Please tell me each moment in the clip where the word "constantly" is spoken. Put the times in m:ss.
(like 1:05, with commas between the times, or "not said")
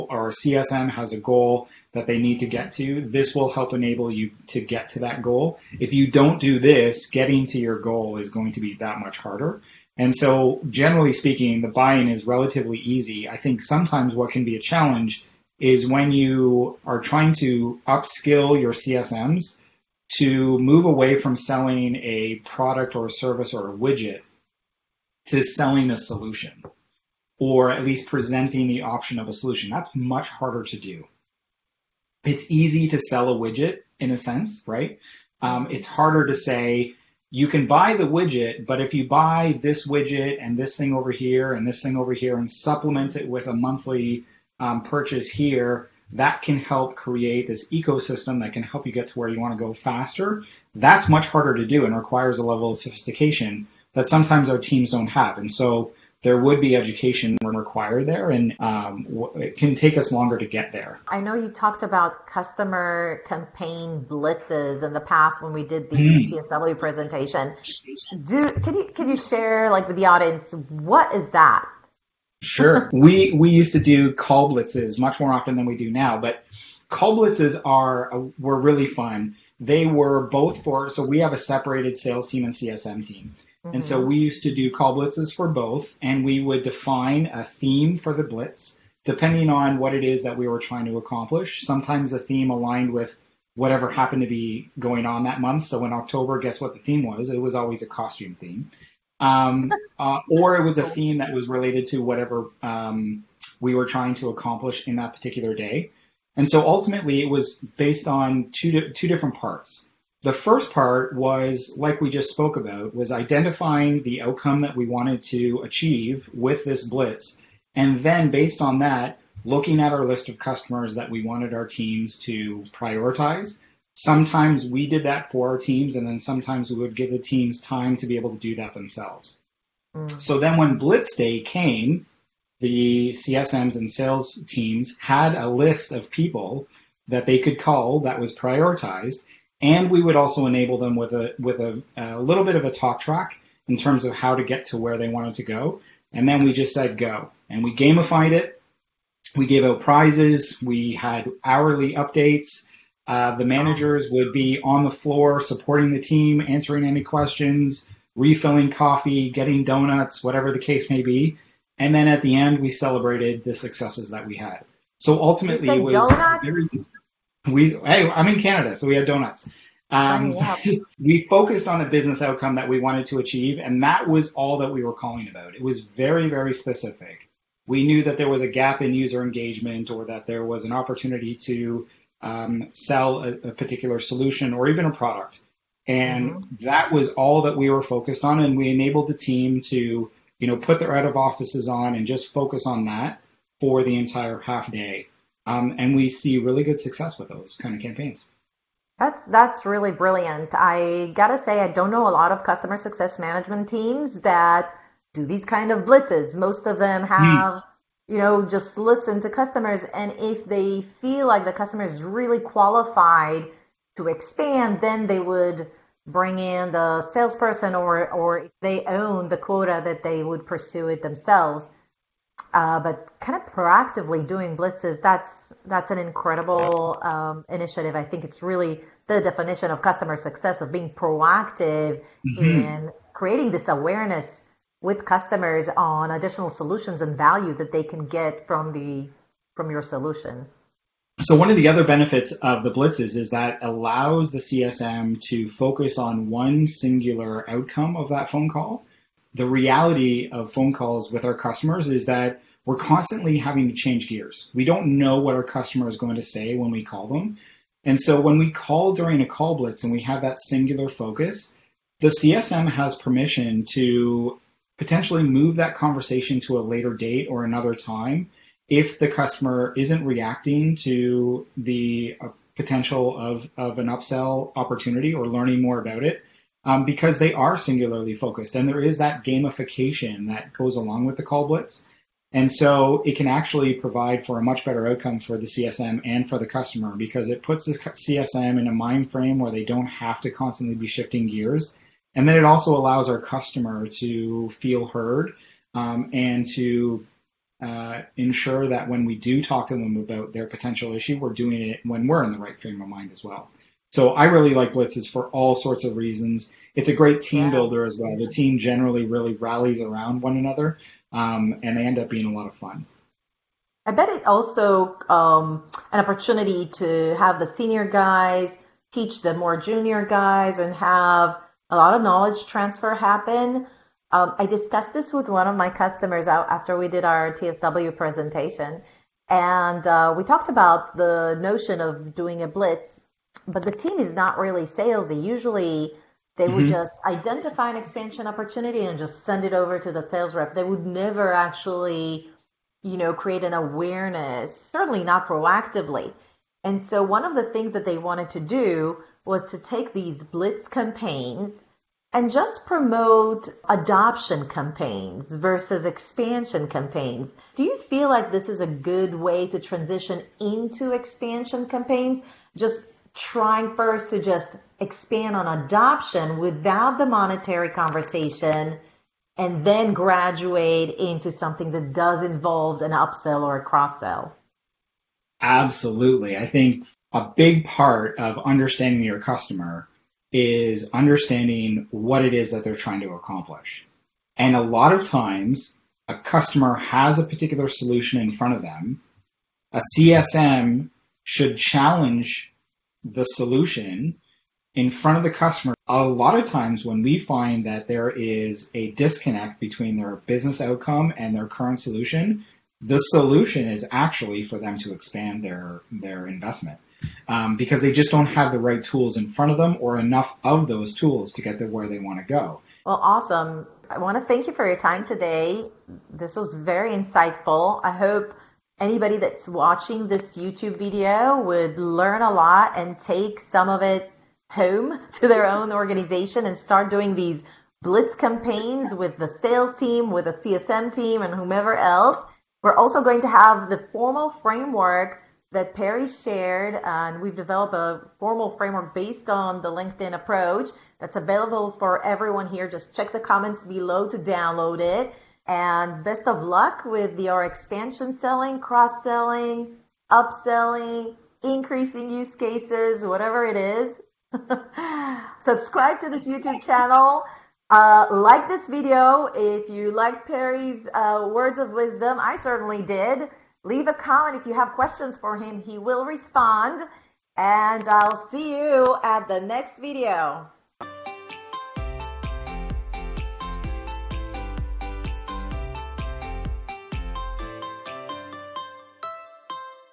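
4:12, 4:50.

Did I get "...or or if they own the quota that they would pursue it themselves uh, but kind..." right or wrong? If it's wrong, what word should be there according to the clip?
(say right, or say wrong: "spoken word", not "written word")
right.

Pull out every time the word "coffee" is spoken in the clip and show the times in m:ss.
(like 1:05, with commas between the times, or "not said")
2:38.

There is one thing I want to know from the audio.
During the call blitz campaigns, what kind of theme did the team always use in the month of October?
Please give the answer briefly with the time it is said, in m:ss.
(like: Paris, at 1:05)
Costume theme, at 1:37.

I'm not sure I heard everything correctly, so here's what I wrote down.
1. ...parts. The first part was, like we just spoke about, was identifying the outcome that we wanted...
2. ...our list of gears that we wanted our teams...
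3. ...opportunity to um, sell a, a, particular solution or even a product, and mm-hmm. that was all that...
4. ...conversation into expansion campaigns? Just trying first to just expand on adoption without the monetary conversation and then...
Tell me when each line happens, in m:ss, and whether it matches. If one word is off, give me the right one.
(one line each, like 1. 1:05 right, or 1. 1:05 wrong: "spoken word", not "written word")
1. 1:49 right
2. 1:59 wrong: "customers", not "gears"
3. 3:00 right
4. 5:59 wrong: "transition", not "conversation".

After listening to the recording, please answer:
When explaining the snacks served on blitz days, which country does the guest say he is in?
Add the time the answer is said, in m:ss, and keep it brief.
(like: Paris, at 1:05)
Canada, at 2:48.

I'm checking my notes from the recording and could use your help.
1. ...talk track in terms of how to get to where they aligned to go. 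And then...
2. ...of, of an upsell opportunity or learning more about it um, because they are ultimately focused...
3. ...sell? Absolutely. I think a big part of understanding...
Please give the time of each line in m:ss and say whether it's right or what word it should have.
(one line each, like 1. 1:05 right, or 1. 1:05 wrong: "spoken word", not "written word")
1. 2:22 wrong: "wanted", not "aligned"
2. 4:33 wrong: "singularly", not "ultimately"
3. 6:14 right.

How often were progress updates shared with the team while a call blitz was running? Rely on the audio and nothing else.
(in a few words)
Hourly.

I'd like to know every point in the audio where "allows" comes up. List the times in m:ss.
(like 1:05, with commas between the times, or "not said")
4:03, 4:52.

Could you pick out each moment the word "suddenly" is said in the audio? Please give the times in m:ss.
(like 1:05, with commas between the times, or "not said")
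not said.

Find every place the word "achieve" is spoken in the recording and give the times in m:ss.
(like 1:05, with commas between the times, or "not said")
1:55, 2:53.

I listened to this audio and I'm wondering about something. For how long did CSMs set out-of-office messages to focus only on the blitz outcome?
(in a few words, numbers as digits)
Half day.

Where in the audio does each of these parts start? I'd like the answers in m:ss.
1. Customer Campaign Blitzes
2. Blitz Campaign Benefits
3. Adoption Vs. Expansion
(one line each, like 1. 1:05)
1. 1:00
2. 4:58
3. 6:01.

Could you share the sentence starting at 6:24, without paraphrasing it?
And a lot of times, a customer has a particular solution in front of them.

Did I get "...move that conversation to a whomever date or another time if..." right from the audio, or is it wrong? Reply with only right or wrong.
wrong.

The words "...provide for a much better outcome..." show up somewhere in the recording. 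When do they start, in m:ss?
4:43.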